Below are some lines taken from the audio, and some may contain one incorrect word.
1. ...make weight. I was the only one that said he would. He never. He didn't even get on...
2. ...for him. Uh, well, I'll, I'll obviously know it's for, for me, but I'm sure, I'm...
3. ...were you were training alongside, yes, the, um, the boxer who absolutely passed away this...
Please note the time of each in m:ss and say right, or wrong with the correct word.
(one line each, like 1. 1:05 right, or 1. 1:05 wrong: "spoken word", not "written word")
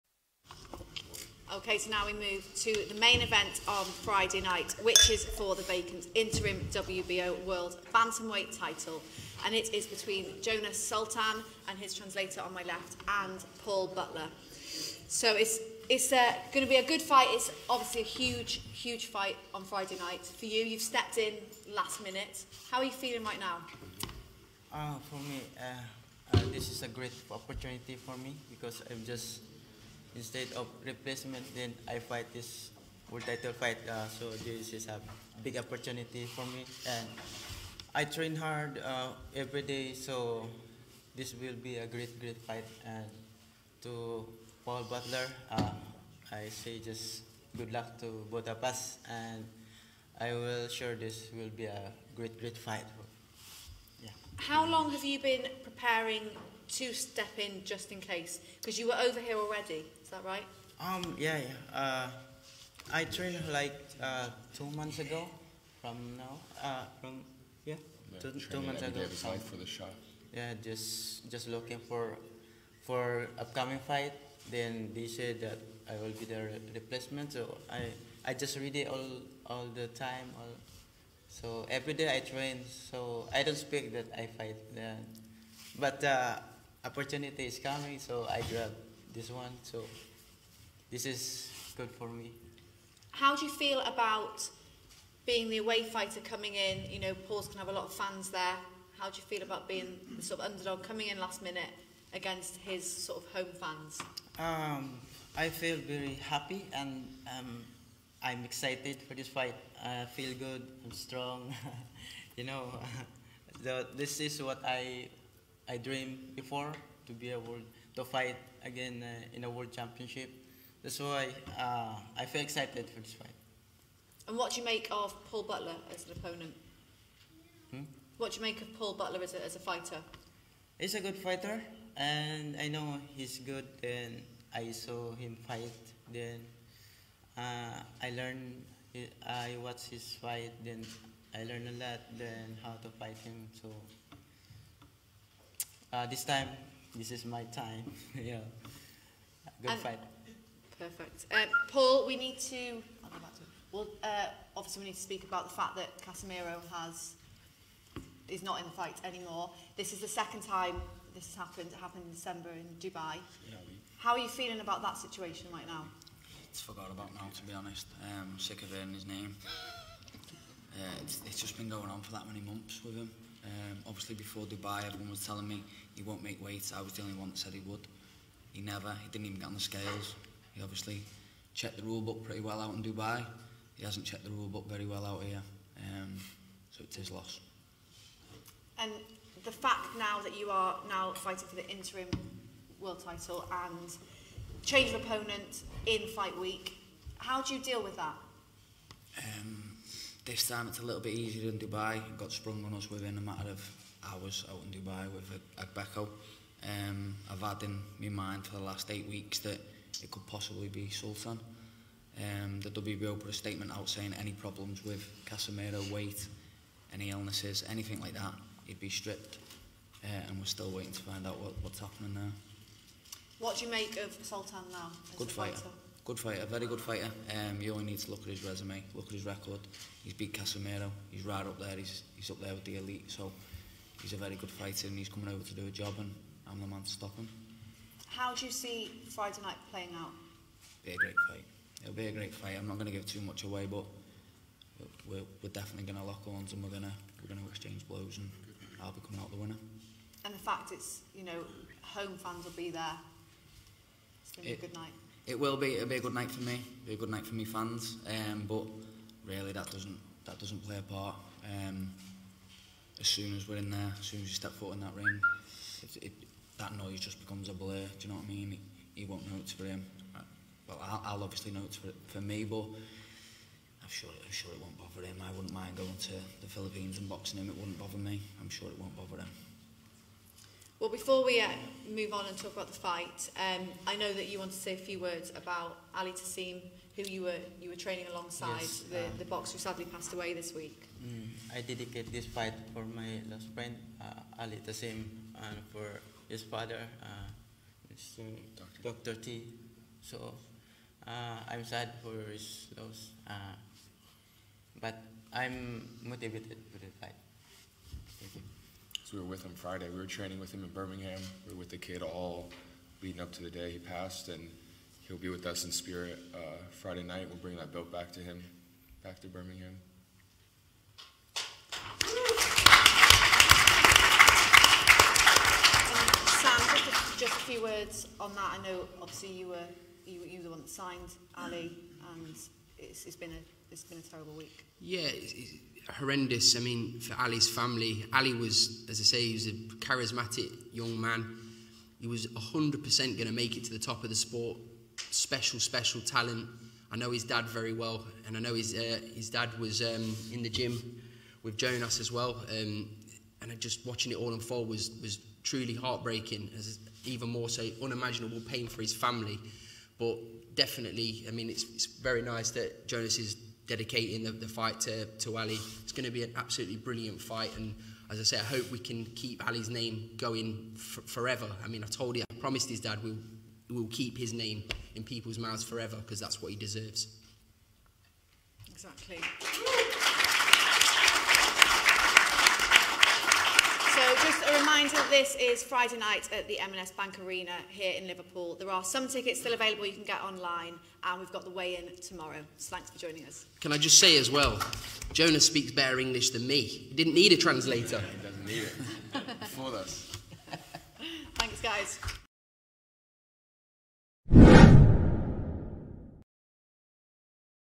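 1. 2:56 right
2. 4:29 right
3. 4:47 wrong: "sadly", not "absolutely".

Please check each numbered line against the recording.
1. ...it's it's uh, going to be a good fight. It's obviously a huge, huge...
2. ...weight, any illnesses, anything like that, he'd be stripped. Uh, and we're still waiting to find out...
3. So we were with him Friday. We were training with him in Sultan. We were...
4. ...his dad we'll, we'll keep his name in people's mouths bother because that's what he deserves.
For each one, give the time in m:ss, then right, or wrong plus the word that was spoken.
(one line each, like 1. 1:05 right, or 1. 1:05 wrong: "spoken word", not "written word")
1. 0:15 right
2. 3:35 right
3. 5:09 wrong: "Birmingham", not "Sultan"
4. 6:12 wrong: "forever", not "bother".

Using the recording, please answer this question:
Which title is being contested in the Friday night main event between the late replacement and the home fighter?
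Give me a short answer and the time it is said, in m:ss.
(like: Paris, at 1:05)
Interim WBO World Bantamweight title, at 0:06.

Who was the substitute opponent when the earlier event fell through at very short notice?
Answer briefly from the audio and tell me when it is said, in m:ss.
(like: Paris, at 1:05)
Agbeko, at 3:25.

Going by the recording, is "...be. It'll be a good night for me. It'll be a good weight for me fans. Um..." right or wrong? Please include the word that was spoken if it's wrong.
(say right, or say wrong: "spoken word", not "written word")
wrong: "night", not "weight".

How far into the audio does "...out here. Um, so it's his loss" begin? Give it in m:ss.
3:05.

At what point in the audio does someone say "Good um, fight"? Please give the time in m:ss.
2:29.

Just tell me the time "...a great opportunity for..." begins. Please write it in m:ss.
0:26.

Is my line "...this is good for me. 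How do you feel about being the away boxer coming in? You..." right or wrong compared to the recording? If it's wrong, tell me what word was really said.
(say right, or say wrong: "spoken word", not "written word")
wrong: "fighter", not "boxer".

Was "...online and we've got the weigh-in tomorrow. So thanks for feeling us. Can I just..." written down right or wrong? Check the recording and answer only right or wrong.
wrong.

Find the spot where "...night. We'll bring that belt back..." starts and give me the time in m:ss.
5:17.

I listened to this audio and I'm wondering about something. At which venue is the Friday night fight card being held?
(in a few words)
M&S Bank Arena.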